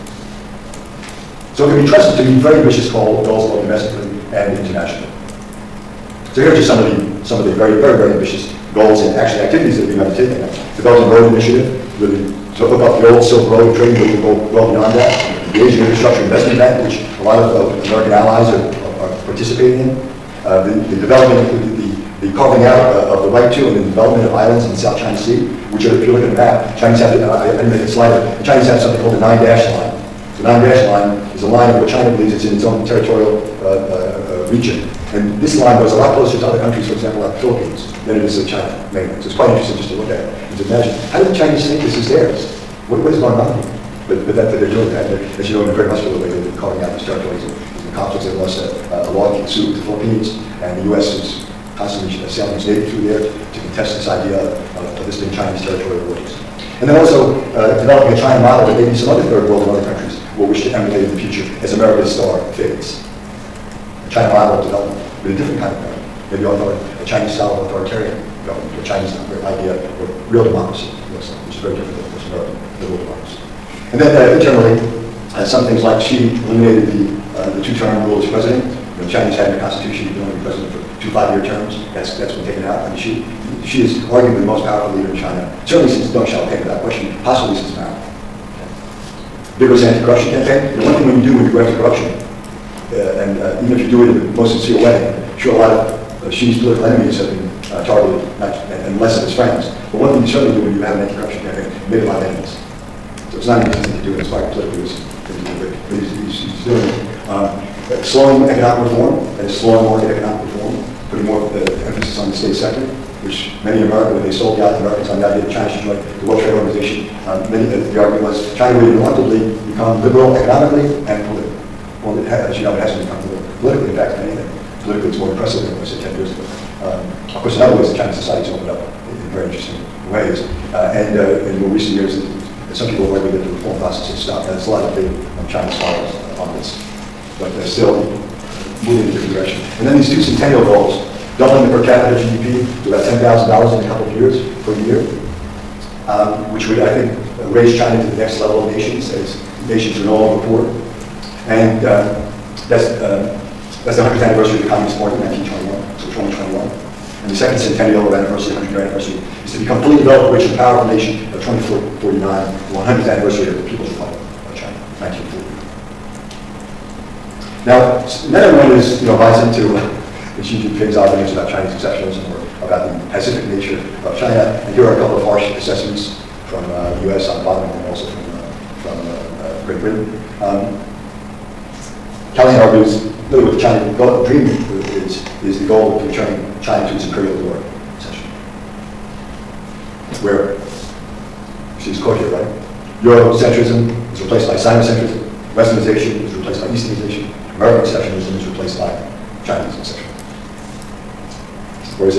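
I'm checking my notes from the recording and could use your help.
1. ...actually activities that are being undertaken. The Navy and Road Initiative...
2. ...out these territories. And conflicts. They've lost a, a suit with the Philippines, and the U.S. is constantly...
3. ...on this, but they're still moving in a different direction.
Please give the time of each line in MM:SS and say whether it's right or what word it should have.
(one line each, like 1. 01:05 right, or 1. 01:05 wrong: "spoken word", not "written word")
1. 00:09 wrong: "Belt", not "Navy"
2. 00:46 right
3. 02:16 right.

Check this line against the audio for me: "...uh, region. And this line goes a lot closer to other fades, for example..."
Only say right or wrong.
wrong.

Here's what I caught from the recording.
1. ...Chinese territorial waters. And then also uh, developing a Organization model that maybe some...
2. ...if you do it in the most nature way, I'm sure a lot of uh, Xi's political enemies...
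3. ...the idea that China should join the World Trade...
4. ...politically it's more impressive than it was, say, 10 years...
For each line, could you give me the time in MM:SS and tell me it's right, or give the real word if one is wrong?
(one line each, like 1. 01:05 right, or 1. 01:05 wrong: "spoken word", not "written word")
1. 00:55 wrong: "China", not "Organization"
2. 01:33 wrong: "sincere", not "nature"
3. 01:55 right
4. 02:04 right.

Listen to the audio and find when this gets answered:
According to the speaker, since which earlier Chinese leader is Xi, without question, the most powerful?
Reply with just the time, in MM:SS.
01:26.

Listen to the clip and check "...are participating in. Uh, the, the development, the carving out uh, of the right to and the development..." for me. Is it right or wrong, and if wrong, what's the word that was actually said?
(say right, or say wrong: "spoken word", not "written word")
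right.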